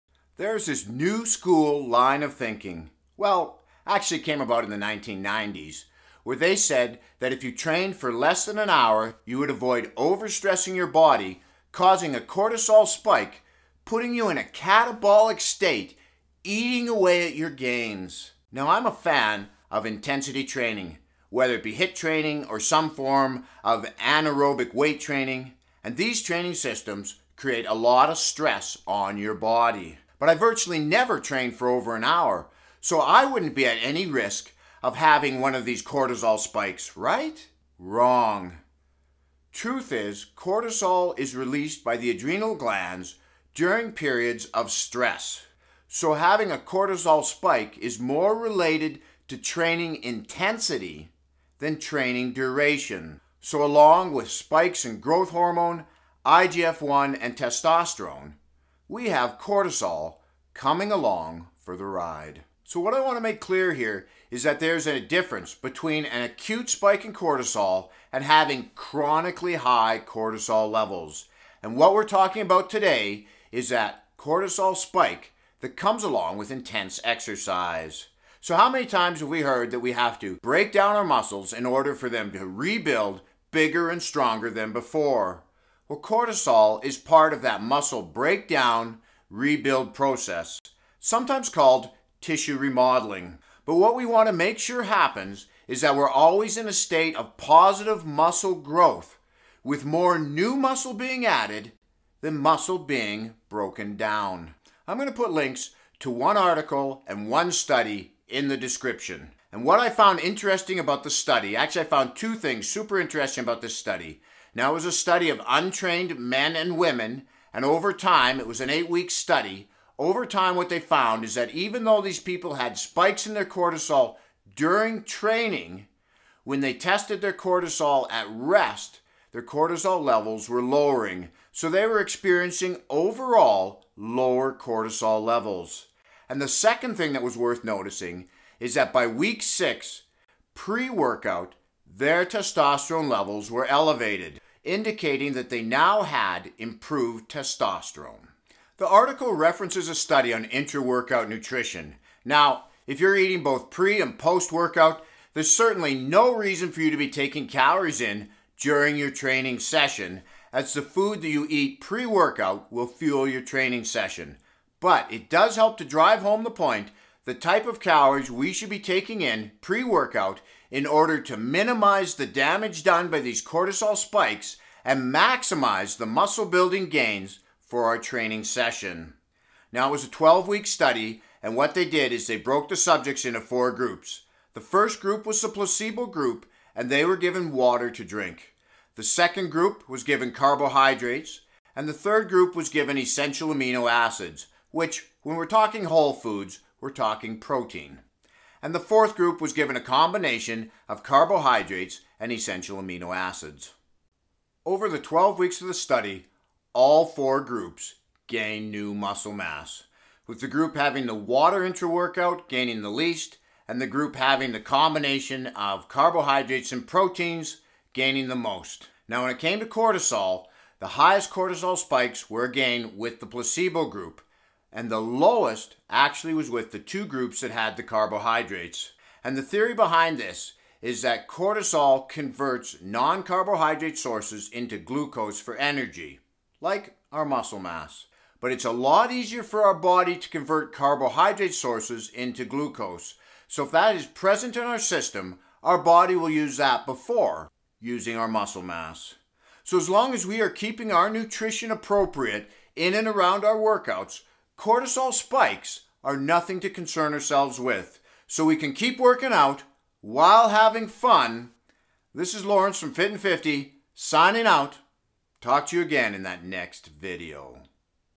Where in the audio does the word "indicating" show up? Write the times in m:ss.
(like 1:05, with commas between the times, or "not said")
2:24.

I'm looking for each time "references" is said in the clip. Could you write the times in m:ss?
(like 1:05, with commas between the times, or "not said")
2:29.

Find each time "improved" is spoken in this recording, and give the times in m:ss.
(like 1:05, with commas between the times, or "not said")
2:26.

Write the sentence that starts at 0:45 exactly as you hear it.
So, having a cortisol spike is more related to training intensity than training duration.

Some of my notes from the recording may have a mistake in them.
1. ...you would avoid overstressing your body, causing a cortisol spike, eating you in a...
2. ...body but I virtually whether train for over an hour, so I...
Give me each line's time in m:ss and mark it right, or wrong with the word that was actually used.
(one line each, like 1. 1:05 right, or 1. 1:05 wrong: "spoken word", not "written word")
1. 0:09 wrong: "putting", not "eating"
2. 0:29 wrong: "never", not "whether".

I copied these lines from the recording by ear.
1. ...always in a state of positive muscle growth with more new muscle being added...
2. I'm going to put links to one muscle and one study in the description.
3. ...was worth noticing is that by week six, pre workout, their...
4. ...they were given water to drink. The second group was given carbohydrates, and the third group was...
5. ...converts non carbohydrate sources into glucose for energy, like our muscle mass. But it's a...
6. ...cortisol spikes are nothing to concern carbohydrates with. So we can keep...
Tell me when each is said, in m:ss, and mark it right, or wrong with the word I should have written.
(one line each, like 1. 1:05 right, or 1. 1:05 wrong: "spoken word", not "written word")
1. 1:36 right
2. 1:44 wrong: "article", not "muscle"
3. 2:17 right
4. 3:06 right
5. 3:52 right
6. 4:14 wrong: "ourselves", not "carbohydrates".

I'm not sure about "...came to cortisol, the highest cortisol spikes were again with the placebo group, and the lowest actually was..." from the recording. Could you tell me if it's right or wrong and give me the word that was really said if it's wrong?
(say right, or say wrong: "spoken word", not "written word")
right.